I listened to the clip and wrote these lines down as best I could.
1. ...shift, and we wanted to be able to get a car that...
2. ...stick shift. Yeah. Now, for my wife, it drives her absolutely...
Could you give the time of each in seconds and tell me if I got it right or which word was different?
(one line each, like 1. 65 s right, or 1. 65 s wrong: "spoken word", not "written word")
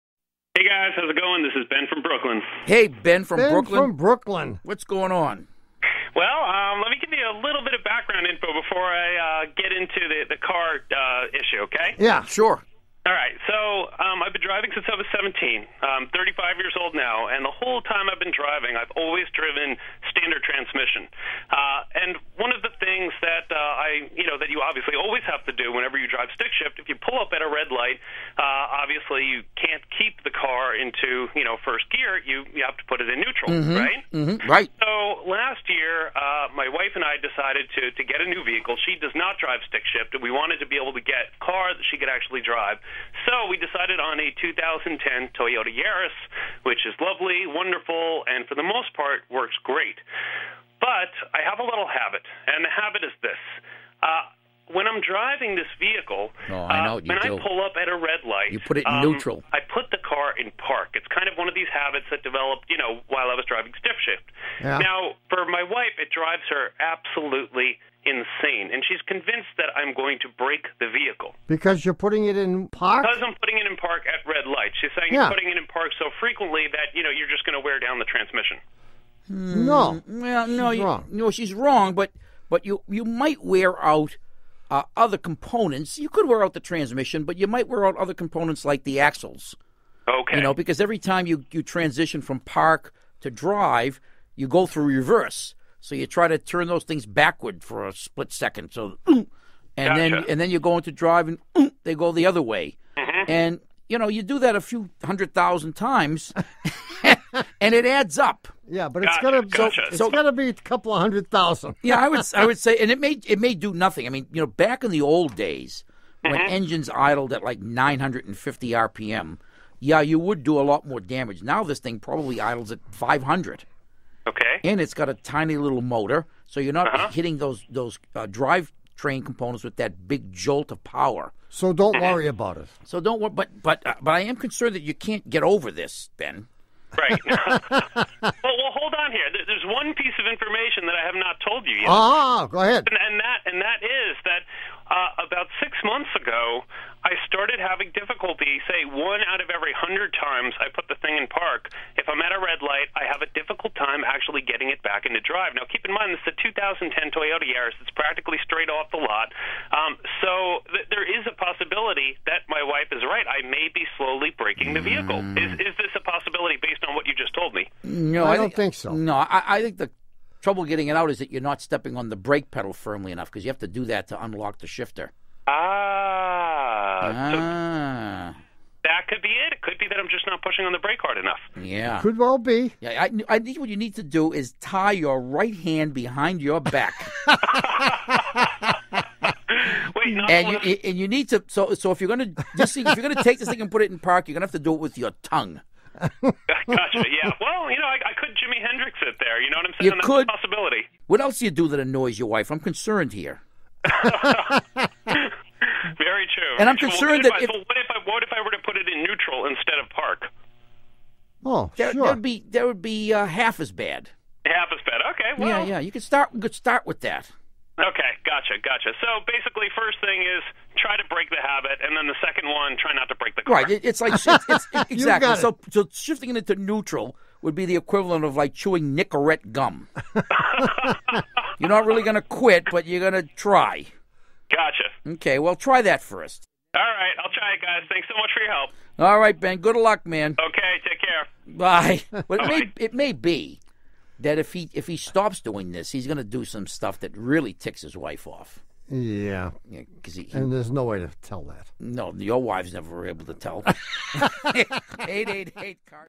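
1. 39 s right
2. 63 s right.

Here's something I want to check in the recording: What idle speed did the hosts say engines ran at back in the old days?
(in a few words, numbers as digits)
950 RPM.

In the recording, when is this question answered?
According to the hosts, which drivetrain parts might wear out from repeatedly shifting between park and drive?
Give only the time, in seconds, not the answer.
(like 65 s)
89 s.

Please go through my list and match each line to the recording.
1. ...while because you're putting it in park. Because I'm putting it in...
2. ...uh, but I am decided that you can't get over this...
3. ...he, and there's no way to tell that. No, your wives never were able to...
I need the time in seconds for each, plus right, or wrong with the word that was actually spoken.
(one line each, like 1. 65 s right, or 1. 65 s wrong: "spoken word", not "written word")
1. 70 s wrong: "vehicle", not "while"
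2. 133 s wrong: "concerned", not "decided"
3. 250 s right.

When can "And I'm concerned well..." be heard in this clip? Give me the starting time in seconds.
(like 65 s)
206 s.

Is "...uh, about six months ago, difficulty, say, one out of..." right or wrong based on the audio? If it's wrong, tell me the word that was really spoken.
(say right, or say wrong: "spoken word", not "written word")
right.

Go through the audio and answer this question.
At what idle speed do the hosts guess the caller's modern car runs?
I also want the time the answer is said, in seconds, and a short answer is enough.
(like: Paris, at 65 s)
500, at 122 s.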